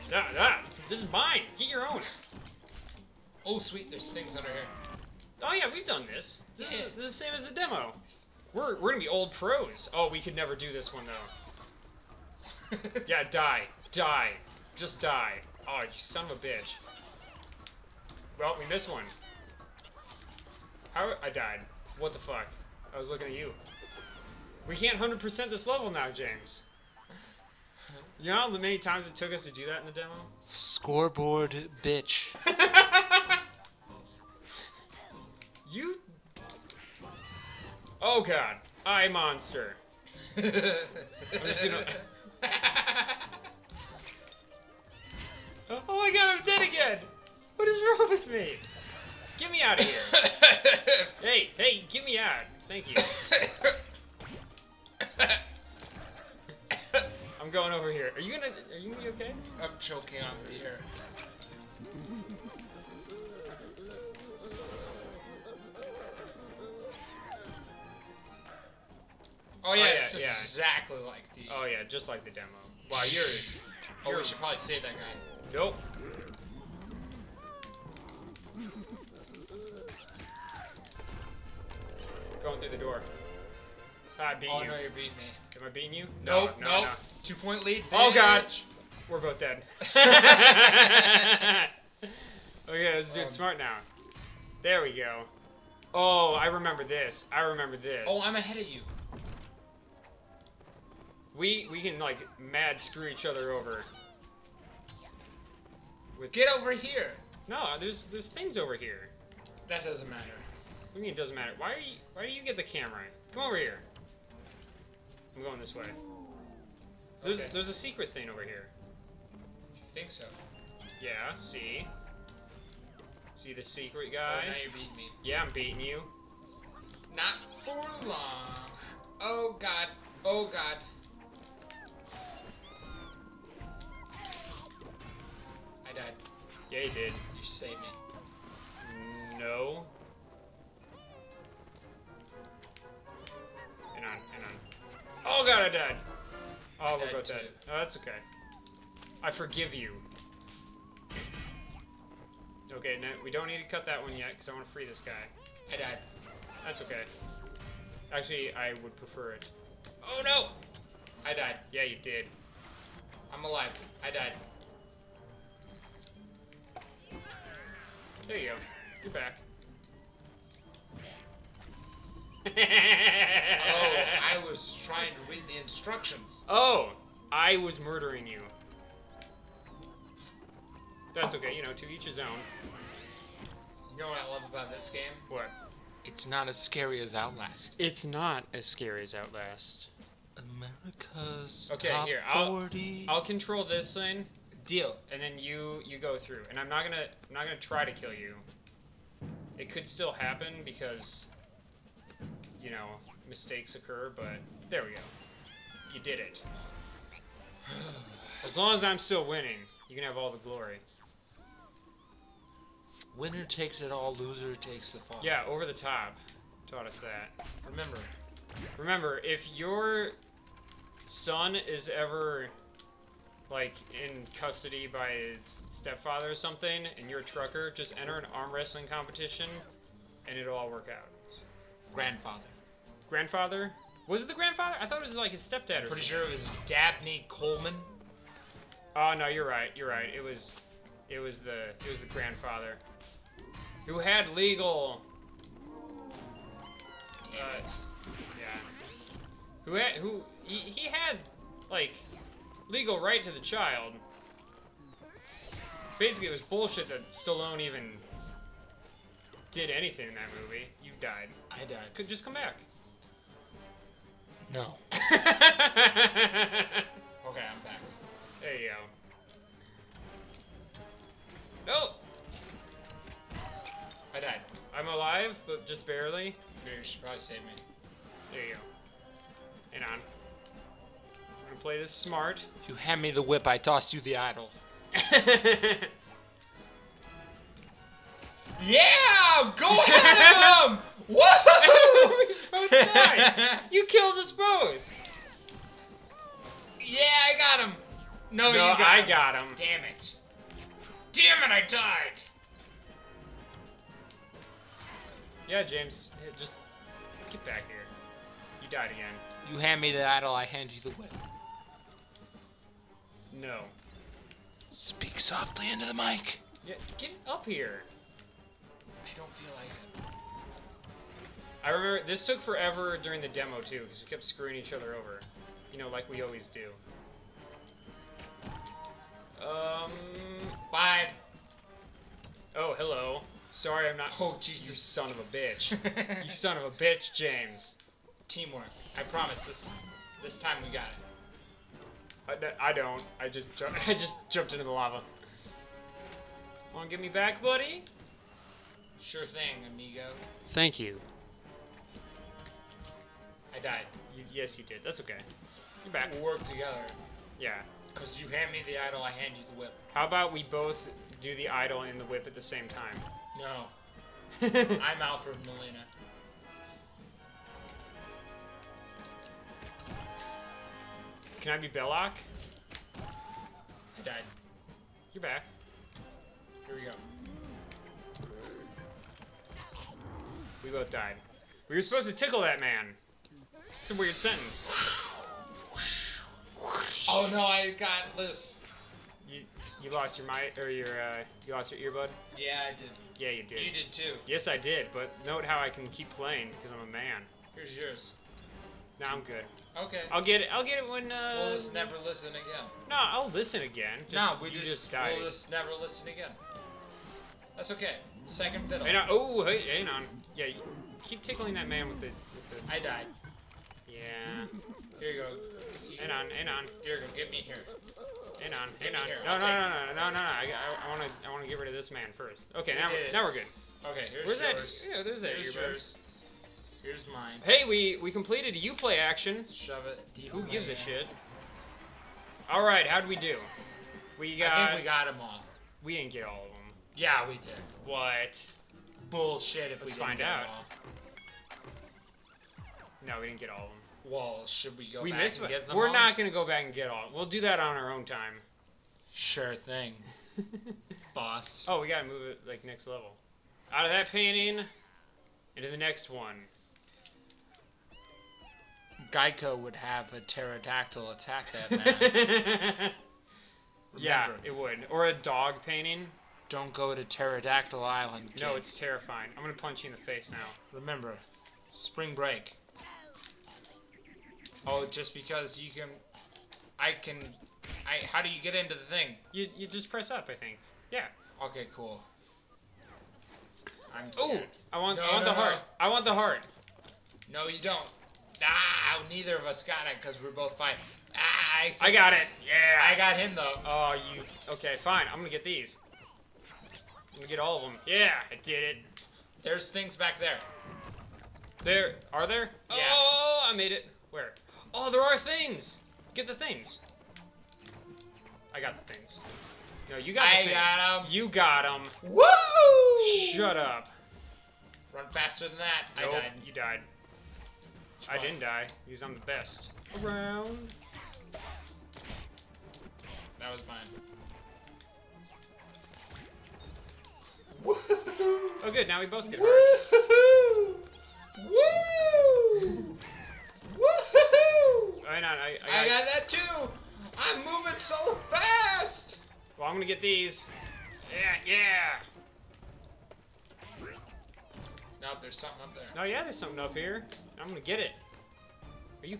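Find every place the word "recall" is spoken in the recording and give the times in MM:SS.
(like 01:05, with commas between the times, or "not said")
not said.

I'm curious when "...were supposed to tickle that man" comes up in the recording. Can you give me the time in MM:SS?
06:21.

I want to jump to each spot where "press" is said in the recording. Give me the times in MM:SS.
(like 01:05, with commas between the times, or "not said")
07:59.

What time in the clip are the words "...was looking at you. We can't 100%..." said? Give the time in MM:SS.
00:22.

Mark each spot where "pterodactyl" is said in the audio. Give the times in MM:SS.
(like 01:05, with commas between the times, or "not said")
07:40, 07:47.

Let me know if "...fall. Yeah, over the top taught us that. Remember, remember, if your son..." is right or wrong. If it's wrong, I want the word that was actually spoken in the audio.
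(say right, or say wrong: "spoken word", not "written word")
right.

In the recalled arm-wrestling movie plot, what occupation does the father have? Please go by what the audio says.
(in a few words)
trucker.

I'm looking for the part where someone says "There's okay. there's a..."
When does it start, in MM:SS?
01:57.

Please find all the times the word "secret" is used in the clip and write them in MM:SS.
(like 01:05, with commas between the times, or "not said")
01:57, 02:03.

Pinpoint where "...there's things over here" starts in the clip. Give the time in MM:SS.
01:48.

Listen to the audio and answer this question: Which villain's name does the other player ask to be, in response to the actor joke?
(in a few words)
Belloc.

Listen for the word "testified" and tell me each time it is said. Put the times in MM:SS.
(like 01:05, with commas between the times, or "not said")
not said.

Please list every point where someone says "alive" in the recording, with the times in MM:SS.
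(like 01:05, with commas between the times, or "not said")
02:43, 04:34.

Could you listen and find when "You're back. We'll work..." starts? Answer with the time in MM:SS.
05:55.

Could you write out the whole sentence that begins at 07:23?
No, we didn't get all of them.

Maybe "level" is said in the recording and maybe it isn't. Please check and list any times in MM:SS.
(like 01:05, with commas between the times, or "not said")
00:25, 07:32.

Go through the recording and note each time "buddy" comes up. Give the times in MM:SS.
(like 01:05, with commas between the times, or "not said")
05:47.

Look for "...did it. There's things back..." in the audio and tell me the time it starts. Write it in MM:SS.
08:18.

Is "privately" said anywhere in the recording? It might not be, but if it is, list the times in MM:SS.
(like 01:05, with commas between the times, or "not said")
not said.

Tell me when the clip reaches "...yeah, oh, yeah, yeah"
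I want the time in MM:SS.
01:09.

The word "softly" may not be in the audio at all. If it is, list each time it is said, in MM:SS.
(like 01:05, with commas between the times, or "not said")
05:15.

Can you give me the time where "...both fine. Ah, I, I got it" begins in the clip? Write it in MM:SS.
08:10.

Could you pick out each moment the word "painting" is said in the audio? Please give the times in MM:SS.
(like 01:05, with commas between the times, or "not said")
07:34, 07:45.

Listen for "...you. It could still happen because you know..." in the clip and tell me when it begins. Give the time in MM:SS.
03:18.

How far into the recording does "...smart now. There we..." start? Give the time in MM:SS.
01:33.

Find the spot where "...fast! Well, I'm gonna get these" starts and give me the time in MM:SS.
08:58.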